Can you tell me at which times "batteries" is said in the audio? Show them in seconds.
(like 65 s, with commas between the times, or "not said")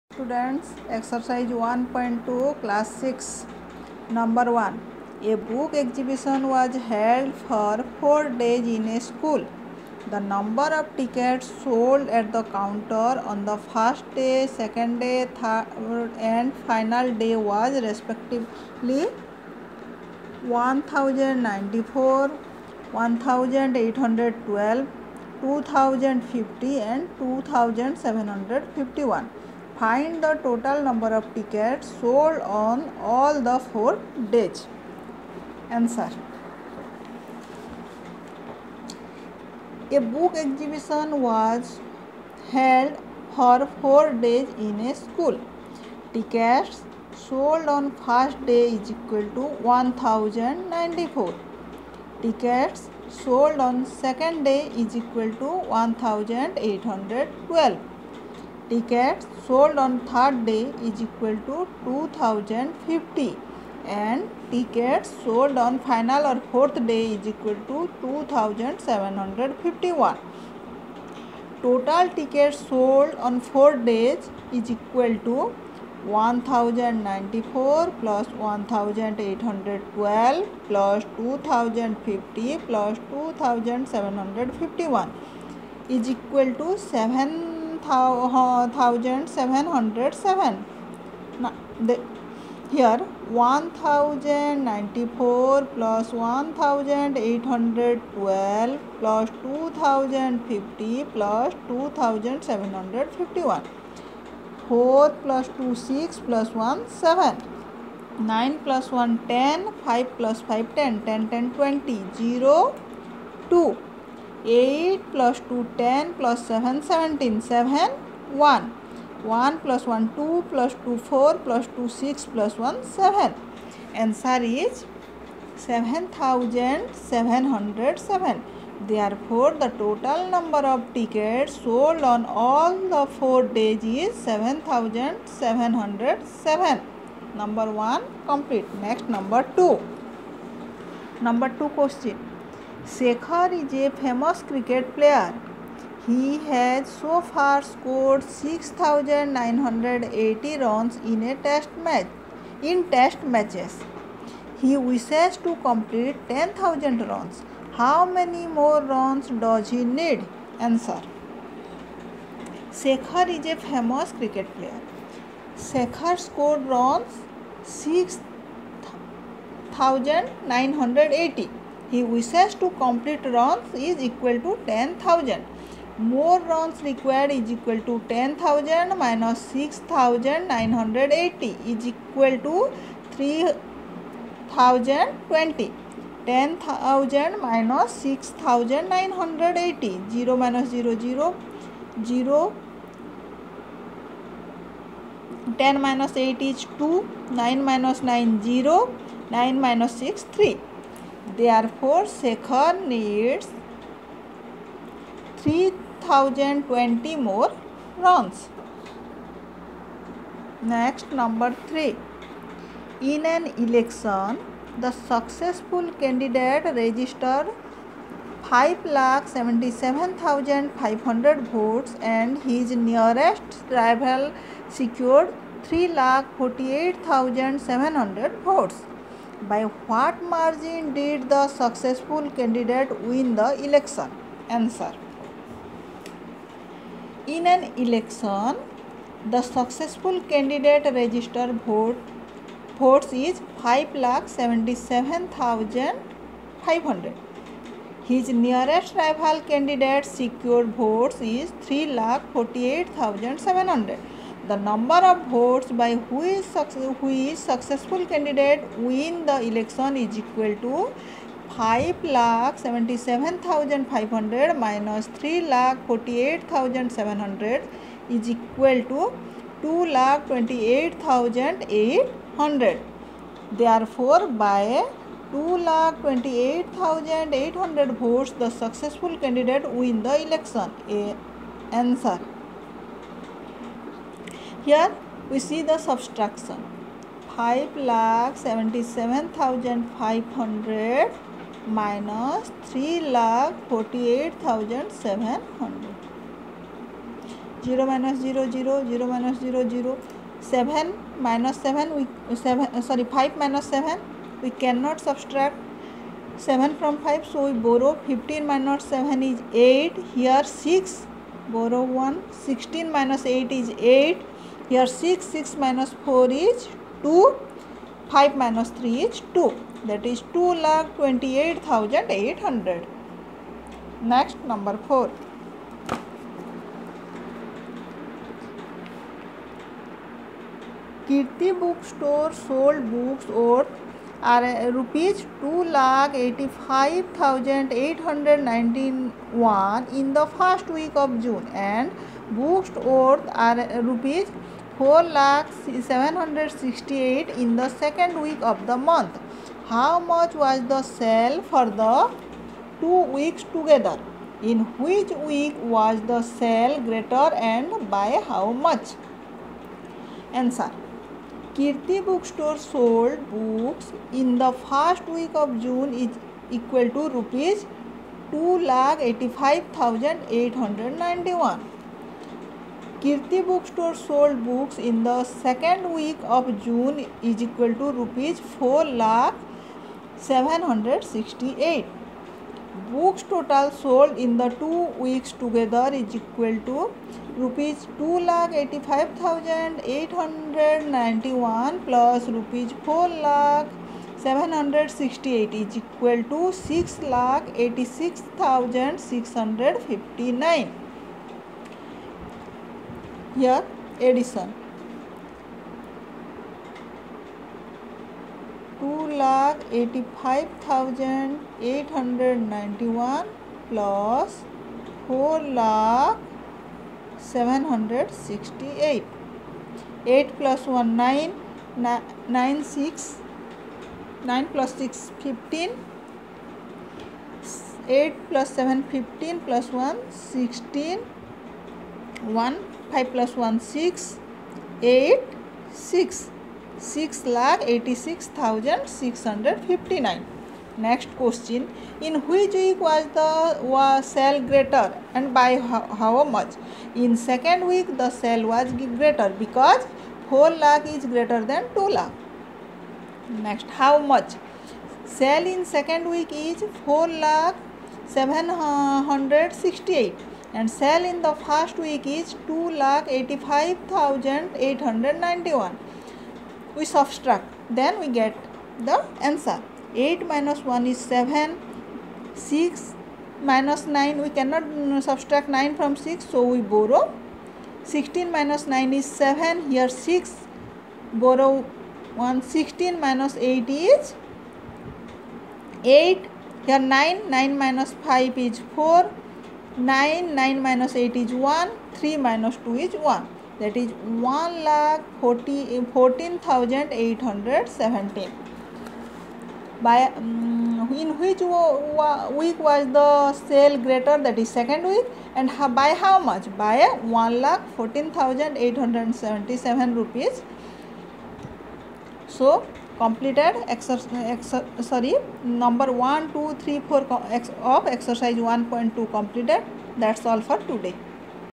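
not said.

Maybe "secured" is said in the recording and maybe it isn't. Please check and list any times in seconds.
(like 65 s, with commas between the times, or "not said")
224 s, 250 s.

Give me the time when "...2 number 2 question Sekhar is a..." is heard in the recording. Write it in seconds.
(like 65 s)
139 s.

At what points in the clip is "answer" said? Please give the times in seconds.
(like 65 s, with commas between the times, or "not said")
35 s, 123 s, 160 s, 234 s, 281 s, 360 s.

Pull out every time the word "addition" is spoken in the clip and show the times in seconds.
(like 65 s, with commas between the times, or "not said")
404 s.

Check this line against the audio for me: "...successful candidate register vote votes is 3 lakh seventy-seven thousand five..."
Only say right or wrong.
wrong.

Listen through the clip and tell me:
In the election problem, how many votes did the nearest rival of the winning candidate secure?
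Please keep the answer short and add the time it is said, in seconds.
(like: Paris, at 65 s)
3,48,700, at 222 s.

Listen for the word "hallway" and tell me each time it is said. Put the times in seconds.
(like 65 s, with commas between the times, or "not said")
not said.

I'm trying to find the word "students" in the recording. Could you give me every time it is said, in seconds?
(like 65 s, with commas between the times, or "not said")
0 s.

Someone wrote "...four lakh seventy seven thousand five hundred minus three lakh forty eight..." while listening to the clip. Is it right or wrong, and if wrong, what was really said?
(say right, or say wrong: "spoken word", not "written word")
wrong: "five", not "four".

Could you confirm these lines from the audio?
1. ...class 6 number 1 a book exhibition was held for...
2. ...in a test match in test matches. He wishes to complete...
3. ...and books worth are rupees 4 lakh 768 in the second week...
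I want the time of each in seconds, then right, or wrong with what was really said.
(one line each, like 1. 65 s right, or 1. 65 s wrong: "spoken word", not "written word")
1. 2 s right
2. 151 s right
3. 341 s right.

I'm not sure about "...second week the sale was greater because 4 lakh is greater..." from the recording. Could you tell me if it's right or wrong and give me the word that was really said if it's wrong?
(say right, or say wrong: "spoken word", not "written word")
right.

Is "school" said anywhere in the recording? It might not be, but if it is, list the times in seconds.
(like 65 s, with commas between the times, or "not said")
9 s, 45 s.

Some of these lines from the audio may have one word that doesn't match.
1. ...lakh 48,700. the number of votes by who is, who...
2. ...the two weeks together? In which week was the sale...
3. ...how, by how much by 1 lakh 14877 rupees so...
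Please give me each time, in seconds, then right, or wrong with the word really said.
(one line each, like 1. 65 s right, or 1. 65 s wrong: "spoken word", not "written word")
1. 252 s right
2. 351 s right
3. 505 s right.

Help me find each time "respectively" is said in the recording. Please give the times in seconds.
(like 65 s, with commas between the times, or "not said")
17 s.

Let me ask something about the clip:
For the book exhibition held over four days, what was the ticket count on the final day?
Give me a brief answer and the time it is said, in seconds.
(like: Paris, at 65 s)
2751, at 65 s.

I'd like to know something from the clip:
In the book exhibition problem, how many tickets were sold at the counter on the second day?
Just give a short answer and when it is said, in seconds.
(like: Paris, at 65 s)
1812, at 52 s.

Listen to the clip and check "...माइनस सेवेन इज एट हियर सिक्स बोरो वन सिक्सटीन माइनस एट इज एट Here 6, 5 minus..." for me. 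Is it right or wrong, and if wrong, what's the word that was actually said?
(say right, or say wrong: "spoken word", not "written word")
wrong: "6", not "5".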